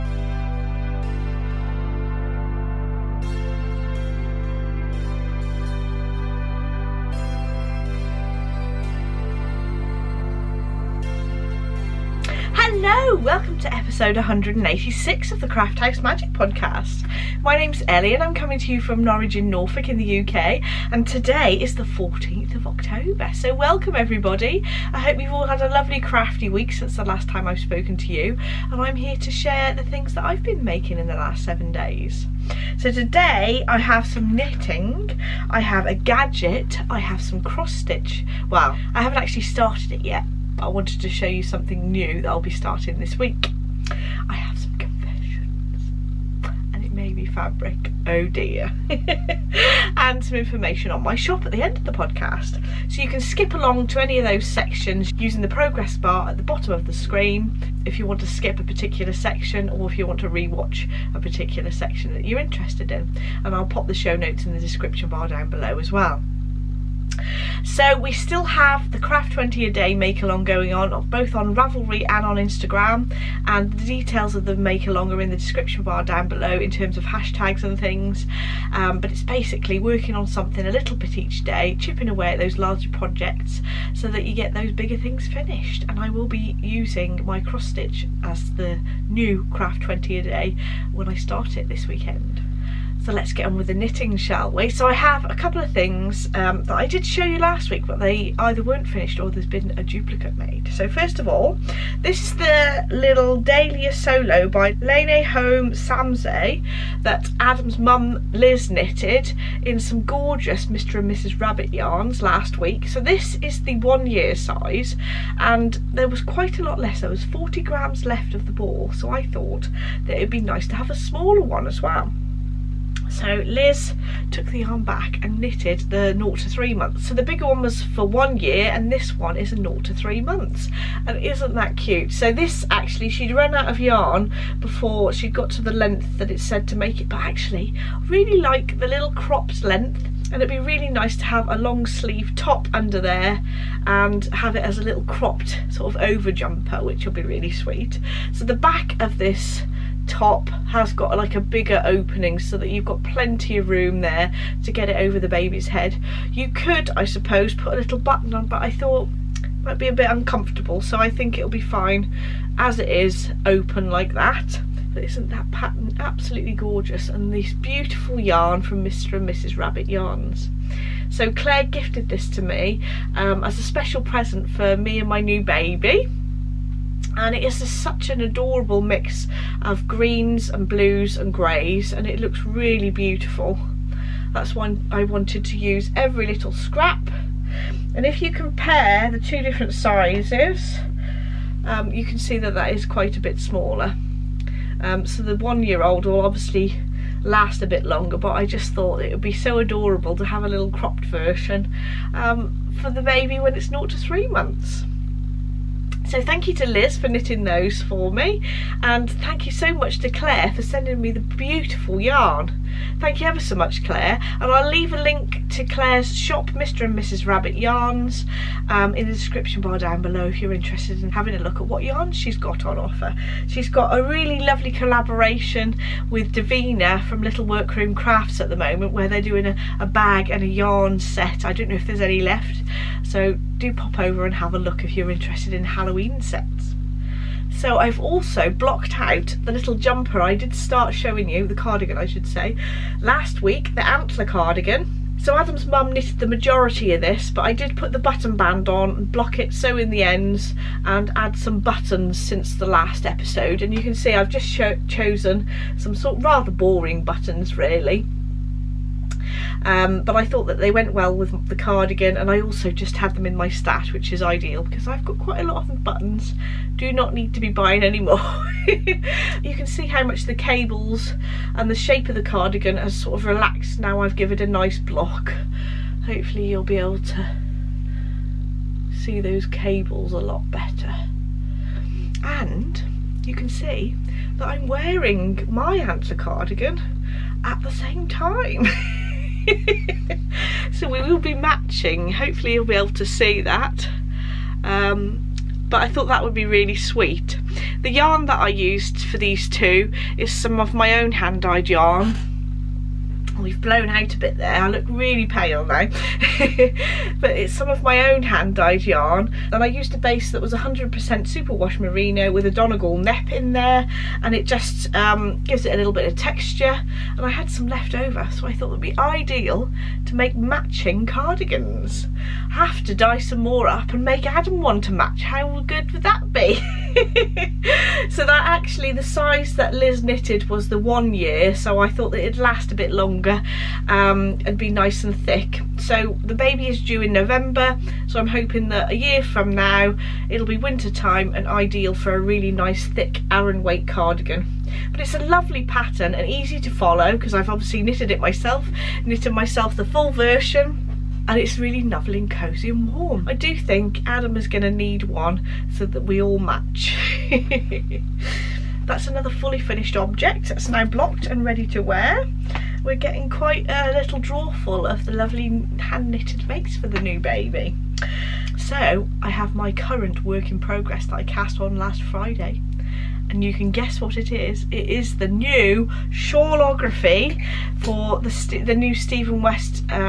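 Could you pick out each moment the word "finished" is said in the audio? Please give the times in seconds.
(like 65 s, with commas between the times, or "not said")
85 s, 98 s, 359 s.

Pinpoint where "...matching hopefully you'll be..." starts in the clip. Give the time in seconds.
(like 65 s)
291 s.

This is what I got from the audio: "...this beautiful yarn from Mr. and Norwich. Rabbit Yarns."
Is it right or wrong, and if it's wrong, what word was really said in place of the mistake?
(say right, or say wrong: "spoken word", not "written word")
wrong: "Mrs", not "Norwich".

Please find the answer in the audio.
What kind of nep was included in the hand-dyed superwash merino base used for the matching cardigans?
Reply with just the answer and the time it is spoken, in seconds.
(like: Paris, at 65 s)
Donegal, at 312 s.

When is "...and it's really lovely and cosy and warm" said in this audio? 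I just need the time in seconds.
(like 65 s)
351 s.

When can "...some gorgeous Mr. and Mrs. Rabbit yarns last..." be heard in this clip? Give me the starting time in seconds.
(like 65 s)
109 s.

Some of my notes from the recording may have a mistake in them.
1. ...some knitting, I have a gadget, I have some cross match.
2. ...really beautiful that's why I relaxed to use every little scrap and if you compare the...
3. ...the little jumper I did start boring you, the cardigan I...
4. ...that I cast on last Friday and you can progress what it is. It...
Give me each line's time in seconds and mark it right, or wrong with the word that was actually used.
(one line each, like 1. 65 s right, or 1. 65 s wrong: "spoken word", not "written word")
1. 34 s wrong: "stitch", not "match"
2. 182 s wrong: "wanted", not "relaxed"
3. 239 s wrong: "showing", not "boring"
4. 371 s wrong: "guess", not "progress".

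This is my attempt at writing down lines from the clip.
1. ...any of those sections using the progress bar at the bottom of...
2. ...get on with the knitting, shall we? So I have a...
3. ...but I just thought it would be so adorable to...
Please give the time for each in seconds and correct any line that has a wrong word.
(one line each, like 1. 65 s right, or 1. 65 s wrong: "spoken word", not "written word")
1. 54 s right
2. 93 s right
3. 198 s right.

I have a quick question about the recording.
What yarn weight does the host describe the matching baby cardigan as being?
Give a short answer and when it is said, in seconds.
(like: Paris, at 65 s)
Aran, at 343 s.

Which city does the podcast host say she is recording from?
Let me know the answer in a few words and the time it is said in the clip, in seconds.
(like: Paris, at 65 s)
Norwich, at 19 s.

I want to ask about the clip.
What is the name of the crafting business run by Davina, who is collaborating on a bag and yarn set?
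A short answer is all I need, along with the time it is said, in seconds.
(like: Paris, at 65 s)
Little Workroom Crafts, at 227 s.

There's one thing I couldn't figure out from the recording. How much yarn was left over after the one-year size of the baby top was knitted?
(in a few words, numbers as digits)
40 grams.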